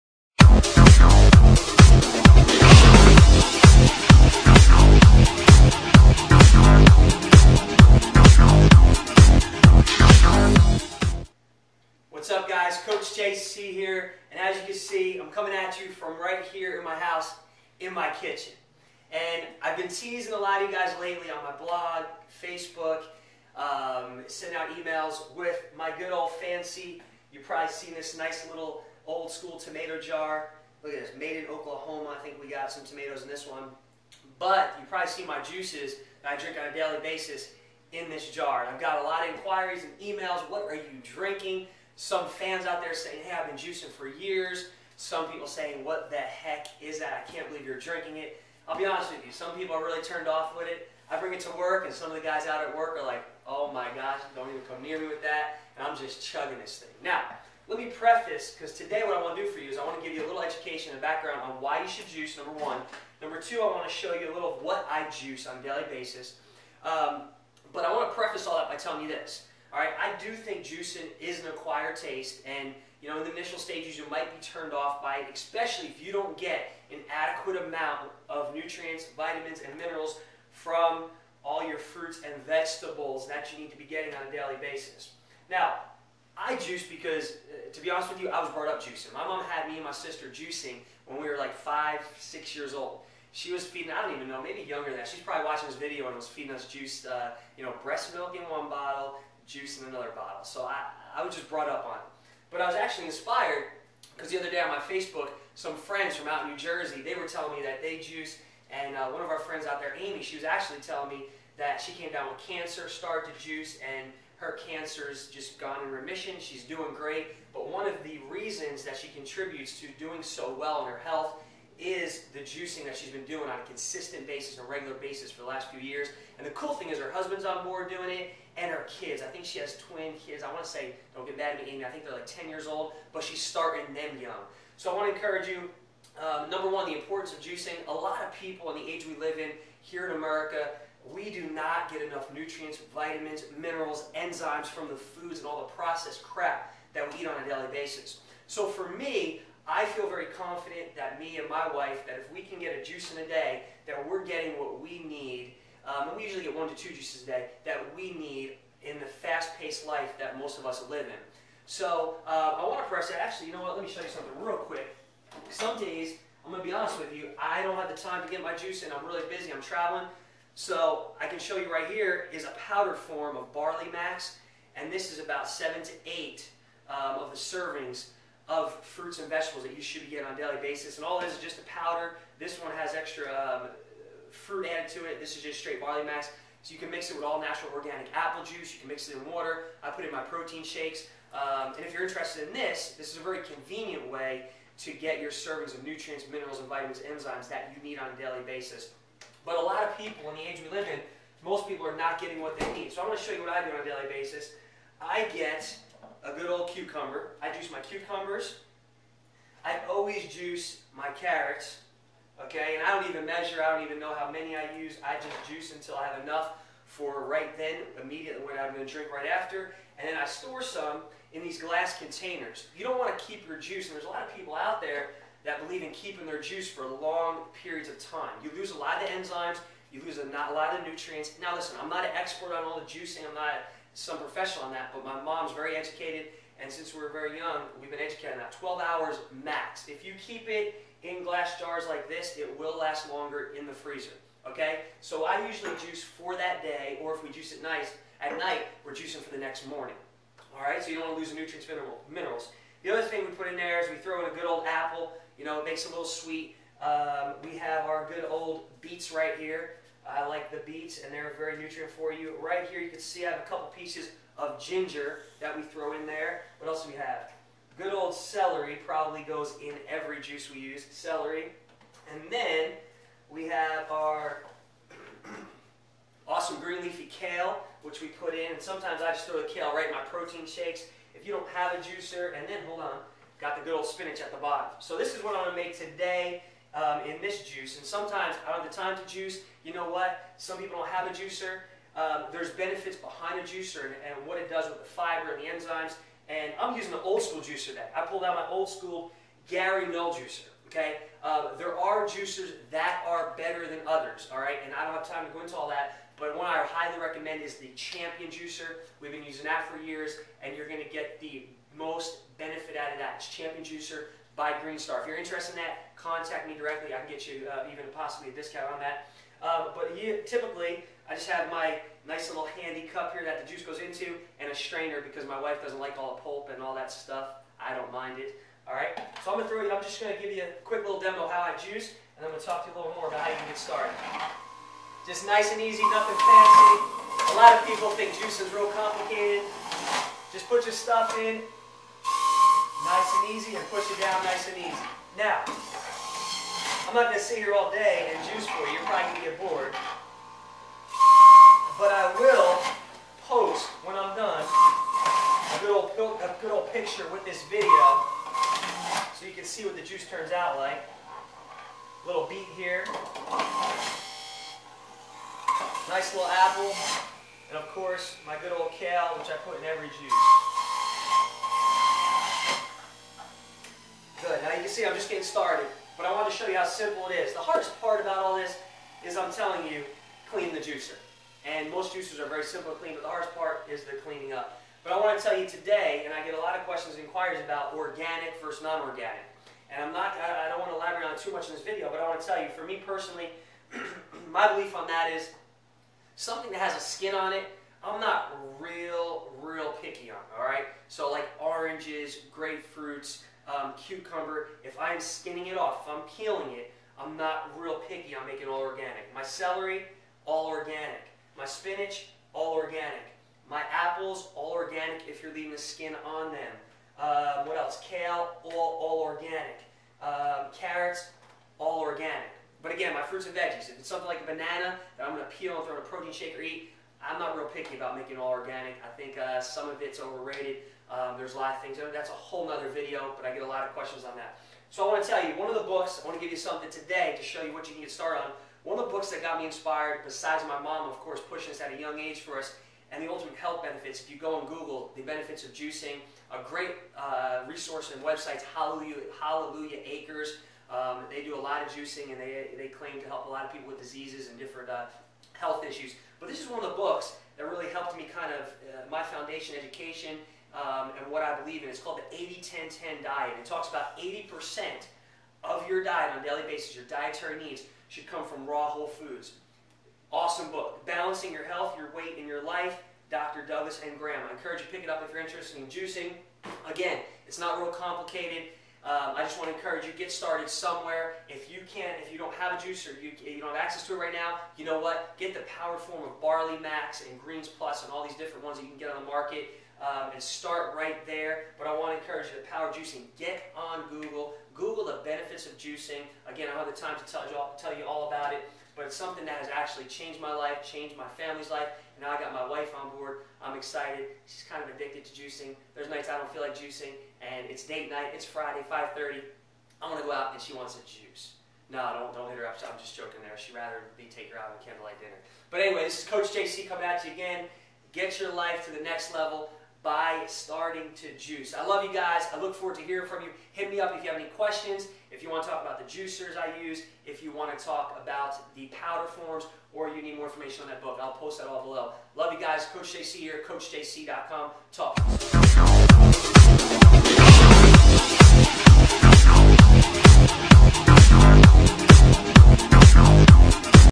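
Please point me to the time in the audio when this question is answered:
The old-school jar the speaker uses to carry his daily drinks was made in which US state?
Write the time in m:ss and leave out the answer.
0:31.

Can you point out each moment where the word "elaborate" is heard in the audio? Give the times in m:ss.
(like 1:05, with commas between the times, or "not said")
6:30.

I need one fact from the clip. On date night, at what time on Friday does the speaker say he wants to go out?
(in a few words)
5:30.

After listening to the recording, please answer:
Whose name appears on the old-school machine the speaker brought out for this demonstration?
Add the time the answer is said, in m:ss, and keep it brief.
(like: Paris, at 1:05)
Gary Null, at 4:59.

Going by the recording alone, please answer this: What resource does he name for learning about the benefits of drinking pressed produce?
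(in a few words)
Hallelujah Acres.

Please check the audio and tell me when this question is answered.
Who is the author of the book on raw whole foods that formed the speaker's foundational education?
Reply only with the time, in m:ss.
7:53.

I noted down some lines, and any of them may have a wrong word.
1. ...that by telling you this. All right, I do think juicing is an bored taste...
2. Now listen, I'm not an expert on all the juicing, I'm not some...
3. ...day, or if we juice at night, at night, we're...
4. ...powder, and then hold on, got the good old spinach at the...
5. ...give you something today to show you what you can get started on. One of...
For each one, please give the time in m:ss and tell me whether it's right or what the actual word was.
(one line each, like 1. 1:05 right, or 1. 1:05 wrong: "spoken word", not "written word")
1. 1:08 wrong: "acquired", not "bored"
2. 3:51 right
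3. 4:06 right
4. 4:41 wrong: "juicer", not "powder"
5. 7:16 right.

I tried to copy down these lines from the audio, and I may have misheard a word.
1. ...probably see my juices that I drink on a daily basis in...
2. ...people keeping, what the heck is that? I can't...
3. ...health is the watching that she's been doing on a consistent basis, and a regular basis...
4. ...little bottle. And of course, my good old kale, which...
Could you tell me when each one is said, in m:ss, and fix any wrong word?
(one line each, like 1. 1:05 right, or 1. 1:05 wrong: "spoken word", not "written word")
1. 0:34 right
2. 0:45 wrong: "saying", not "keeping"
3. 2:00 wrong: "juicing", not "watching"
4. 6:06 wrong: "apple", not "bottle".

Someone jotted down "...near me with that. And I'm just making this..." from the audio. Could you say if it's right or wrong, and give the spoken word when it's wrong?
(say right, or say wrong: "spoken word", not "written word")
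wrong: "chugging", not "making".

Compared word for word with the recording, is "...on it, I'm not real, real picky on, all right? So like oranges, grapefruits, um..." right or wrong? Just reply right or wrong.
right.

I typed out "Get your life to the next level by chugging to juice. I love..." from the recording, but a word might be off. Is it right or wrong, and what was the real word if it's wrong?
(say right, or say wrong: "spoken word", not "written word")
wrong: "starting", not "chugging".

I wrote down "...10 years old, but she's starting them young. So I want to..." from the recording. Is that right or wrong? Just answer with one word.
right.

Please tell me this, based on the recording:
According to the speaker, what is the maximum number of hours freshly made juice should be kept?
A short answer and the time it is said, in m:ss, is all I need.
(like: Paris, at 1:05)
12, at 3:58.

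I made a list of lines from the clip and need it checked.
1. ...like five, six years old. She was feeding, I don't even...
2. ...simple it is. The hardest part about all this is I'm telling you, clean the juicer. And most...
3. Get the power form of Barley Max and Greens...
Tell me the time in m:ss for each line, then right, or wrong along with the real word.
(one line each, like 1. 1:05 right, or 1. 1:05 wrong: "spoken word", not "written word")
1. 1:31 right
2. 6:16 right
3. 8:05 right.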